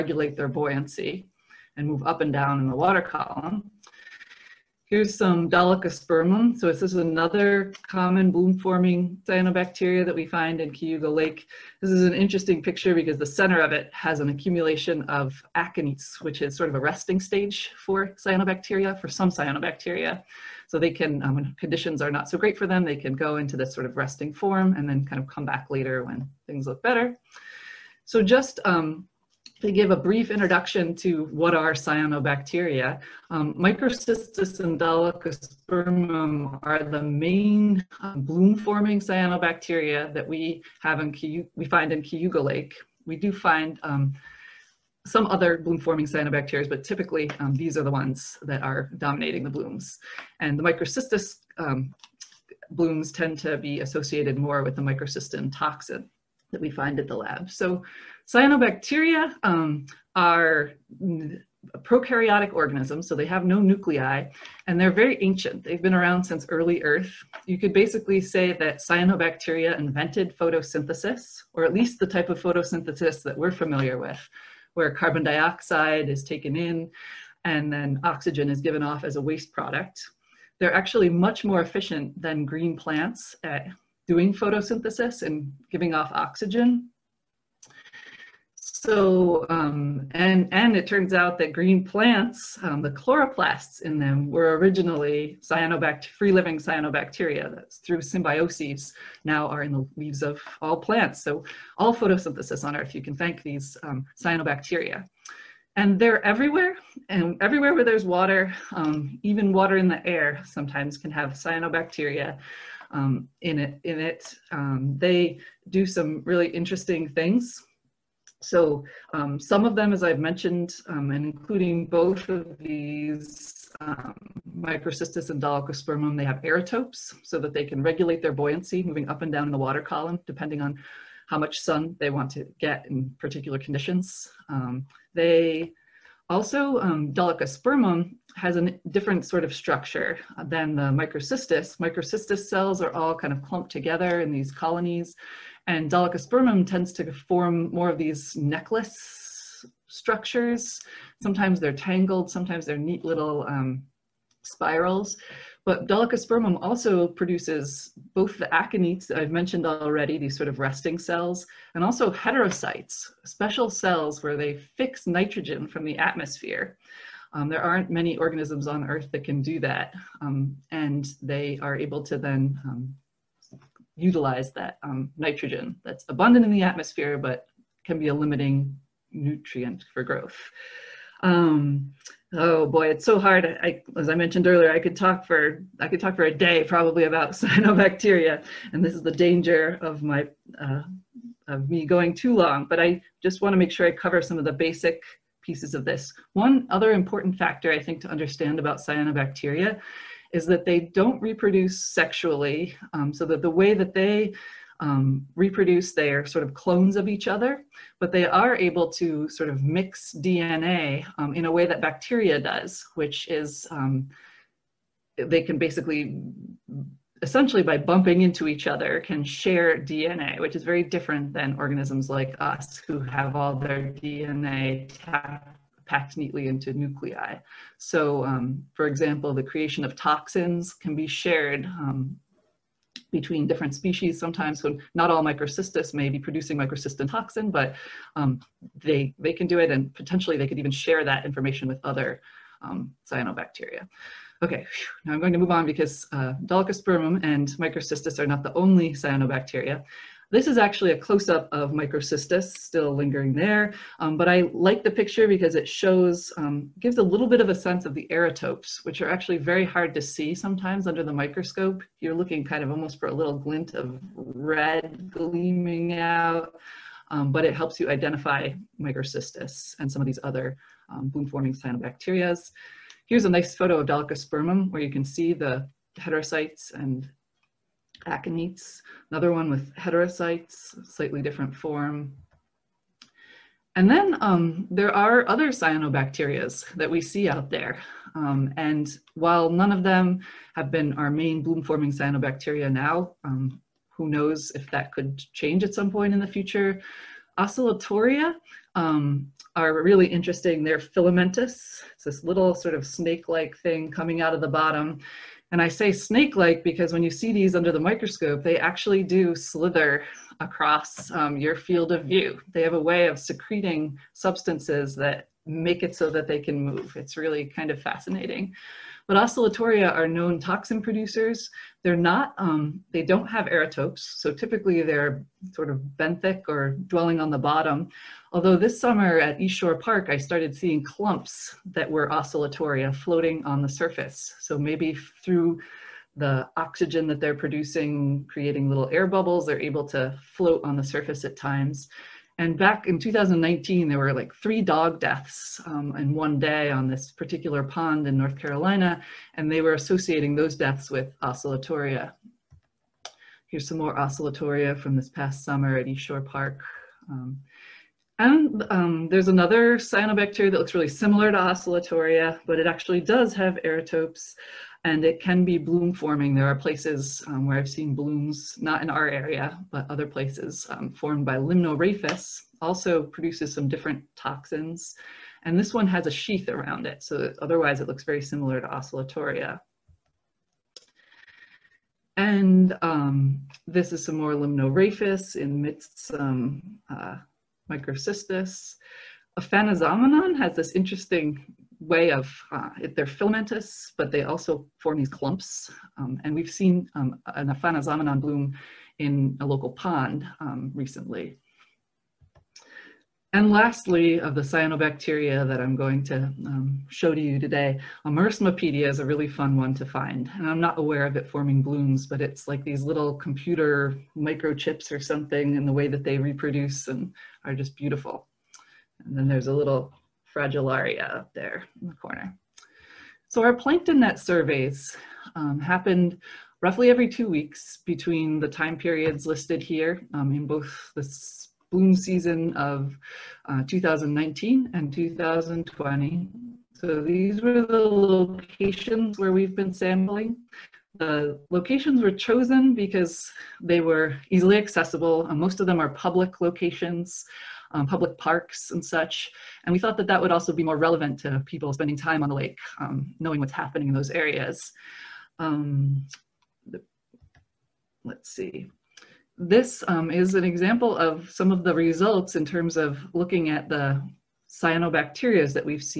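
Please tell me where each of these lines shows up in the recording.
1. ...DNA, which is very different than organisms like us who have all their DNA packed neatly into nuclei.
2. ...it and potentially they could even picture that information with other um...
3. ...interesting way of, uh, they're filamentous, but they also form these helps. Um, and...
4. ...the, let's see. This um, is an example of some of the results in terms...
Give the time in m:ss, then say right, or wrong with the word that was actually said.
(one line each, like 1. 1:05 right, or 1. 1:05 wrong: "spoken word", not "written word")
1. 3:39 right
2. 3:59 wrong: "share", not "picture"
3. 6:30 wrong: "clumps", not "helps"
4. 7:36 right.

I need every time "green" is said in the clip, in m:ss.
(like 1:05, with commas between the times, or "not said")
1:22, 1:31.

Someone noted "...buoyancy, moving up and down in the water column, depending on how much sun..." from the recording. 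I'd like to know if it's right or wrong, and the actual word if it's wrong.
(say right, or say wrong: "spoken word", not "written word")
right.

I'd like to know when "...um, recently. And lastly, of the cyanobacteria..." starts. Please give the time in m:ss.
6:40.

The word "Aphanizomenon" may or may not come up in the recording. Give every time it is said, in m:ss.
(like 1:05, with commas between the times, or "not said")
6:29, 6:37.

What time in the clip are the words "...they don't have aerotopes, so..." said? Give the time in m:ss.
5:22.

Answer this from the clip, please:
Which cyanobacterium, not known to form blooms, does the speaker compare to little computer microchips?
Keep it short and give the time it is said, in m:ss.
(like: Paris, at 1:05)
Merismopedia, at 6:48.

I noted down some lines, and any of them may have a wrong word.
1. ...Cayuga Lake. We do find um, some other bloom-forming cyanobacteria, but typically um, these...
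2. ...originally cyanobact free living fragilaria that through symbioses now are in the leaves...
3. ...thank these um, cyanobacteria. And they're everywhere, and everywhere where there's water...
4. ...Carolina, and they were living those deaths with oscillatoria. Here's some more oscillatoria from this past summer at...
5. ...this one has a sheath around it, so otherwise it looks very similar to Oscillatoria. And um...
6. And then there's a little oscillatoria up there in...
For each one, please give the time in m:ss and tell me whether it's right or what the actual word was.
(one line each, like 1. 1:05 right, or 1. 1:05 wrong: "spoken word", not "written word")
1. 0:42 right
2. 1:34 wrong: "cyanobacteria", not "fragilaria"
3. 1:43 right
4. 5:48 wrong: "associating", not "living"
5. 6:15 right
6. 6:59 wrong: "fragilaria", not "oscillatoria".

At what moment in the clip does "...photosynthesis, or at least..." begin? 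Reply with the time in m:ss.
1:10.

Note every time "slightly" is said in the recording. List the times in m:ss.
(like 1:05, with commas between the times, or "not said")
4:40.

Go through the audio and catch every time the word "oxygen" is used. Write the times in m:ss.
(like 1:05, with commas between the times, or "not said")
1:18, 1:26, 5:36.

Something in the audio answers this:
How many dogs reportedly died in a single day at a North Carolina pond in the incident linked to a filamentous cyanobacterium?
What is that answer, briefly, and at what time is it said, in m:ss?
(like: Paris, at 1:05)
3, at 5:44.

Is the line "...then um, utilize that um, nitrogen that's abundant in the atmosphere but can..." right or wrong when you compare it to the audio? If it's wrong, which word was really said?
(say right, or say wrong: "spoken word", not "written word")
right.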